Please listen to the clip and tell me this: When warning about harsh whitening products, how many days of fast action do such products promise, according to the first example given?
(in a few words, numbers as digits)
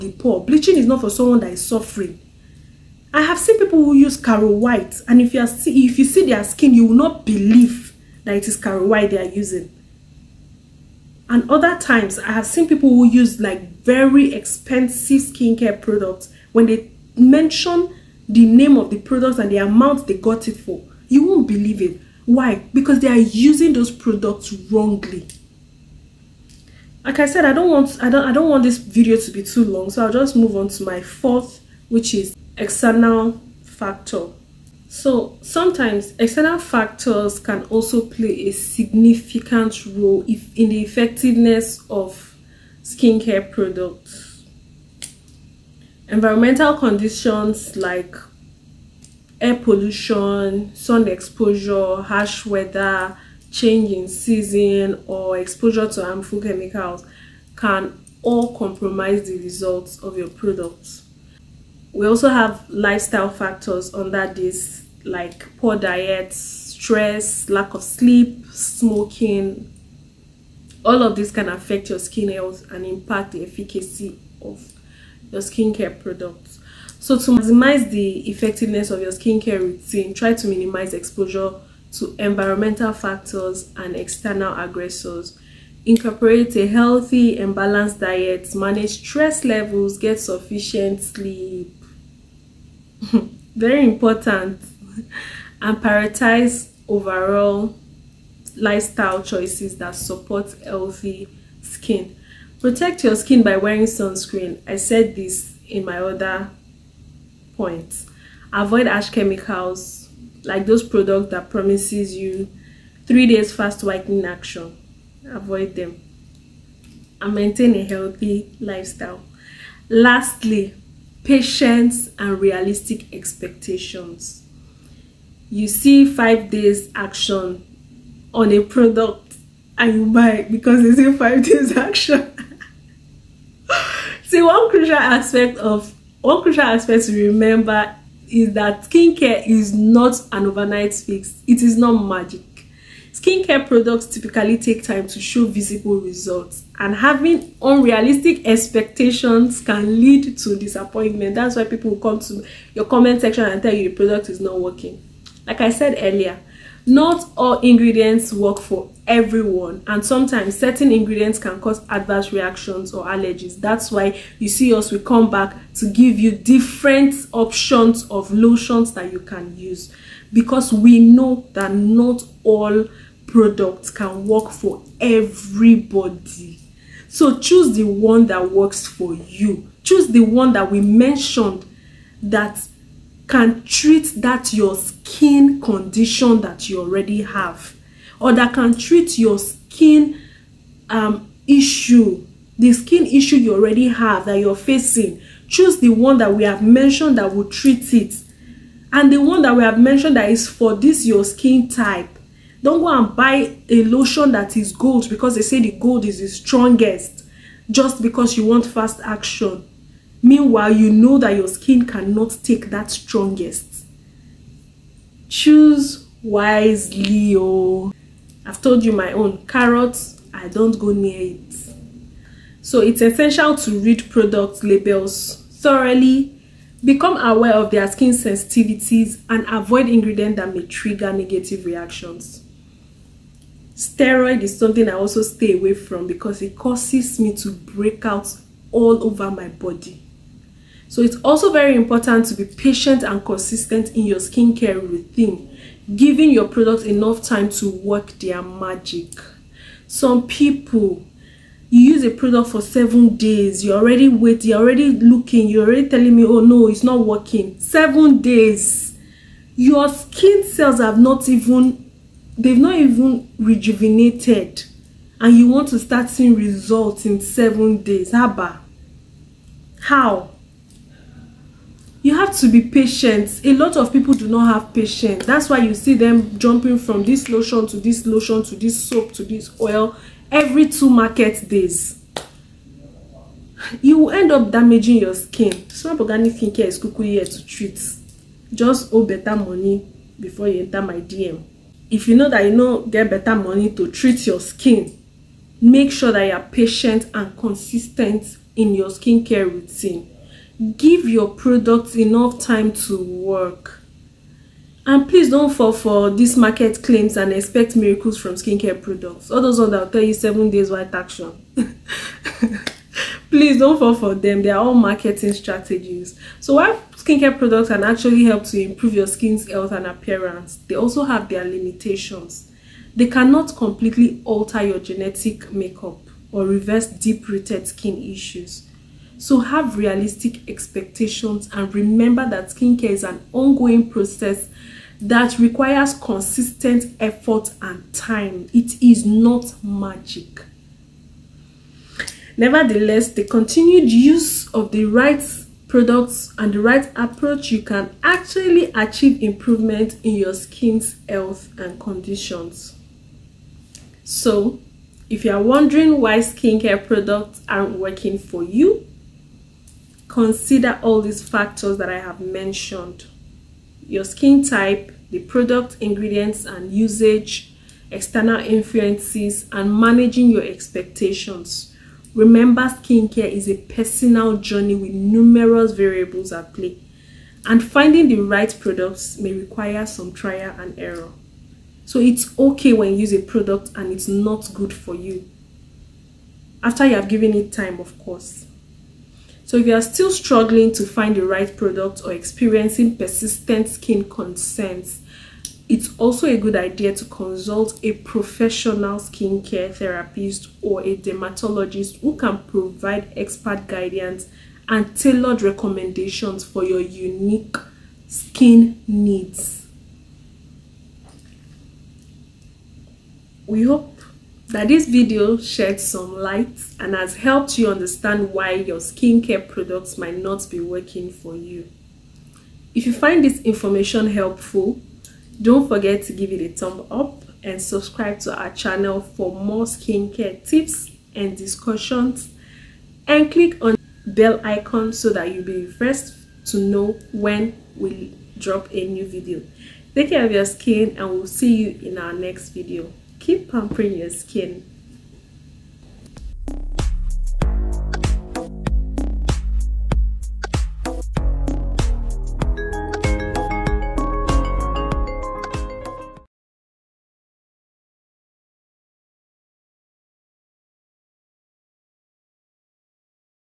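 3.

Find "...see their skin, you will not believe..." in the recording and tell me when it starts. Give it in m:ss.
0:06.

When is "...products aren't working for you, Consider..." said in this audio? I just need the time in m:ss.
5:56.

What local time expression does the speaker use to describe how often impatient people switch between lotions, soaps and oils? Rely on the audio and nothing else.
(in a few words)
every two market days.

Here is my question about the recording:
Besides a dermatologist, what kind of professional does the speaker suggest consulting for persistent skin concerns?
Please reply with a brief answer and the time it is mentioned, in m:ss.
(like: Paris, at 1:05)
skincare therapist, at 6:38.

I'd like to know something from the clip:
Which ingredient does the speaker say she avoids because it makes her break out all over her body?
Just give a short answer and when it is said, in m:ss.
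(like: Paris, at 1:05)
Steroid, at 3:53.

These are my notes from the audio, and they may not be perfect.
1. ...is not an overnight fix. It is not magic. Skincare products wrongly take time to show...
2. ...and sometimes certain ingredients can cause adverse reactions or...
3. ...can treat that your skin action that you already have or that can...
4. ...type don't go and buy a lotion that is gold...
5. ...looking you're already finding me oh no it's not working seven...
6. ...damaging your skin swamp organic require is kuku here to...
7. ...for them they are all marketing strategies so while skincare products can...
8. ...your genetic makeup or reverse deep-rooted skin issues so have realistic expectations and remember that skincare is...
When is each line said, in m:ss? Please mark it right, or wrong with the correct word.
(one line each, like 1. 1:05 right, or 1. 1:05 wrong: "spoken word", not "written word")
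1. 2:19 wrong: "typically", not "wrongly"
2. 2:39 right
3. 3:03 wrong: "condition", not "action"
4. 3:21 right
5. 4:14 wrong: "telling", not "finding"
6. 4:44 wrong: "skincare", not "require"
7. 5:13 right
8. 5:24 right.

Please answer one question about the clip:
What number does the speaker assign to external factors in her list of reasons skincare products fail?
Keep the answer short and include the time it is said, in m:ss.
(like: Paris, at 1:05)
4, at 0:31.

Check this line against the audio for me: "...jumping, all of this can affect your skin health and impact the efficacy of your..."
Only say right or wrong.
wrong.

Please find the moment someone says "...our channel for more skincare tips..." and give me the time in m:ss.
7:08.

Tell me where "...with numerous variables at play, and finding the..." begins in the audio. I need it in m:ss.
6:14.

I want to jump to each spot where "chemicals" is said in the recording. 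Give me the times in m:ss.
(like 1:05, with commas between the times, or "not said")
0:56, 1:49.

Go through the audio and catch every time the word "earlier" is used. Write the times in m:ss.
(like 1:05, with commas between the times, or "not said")
2:36.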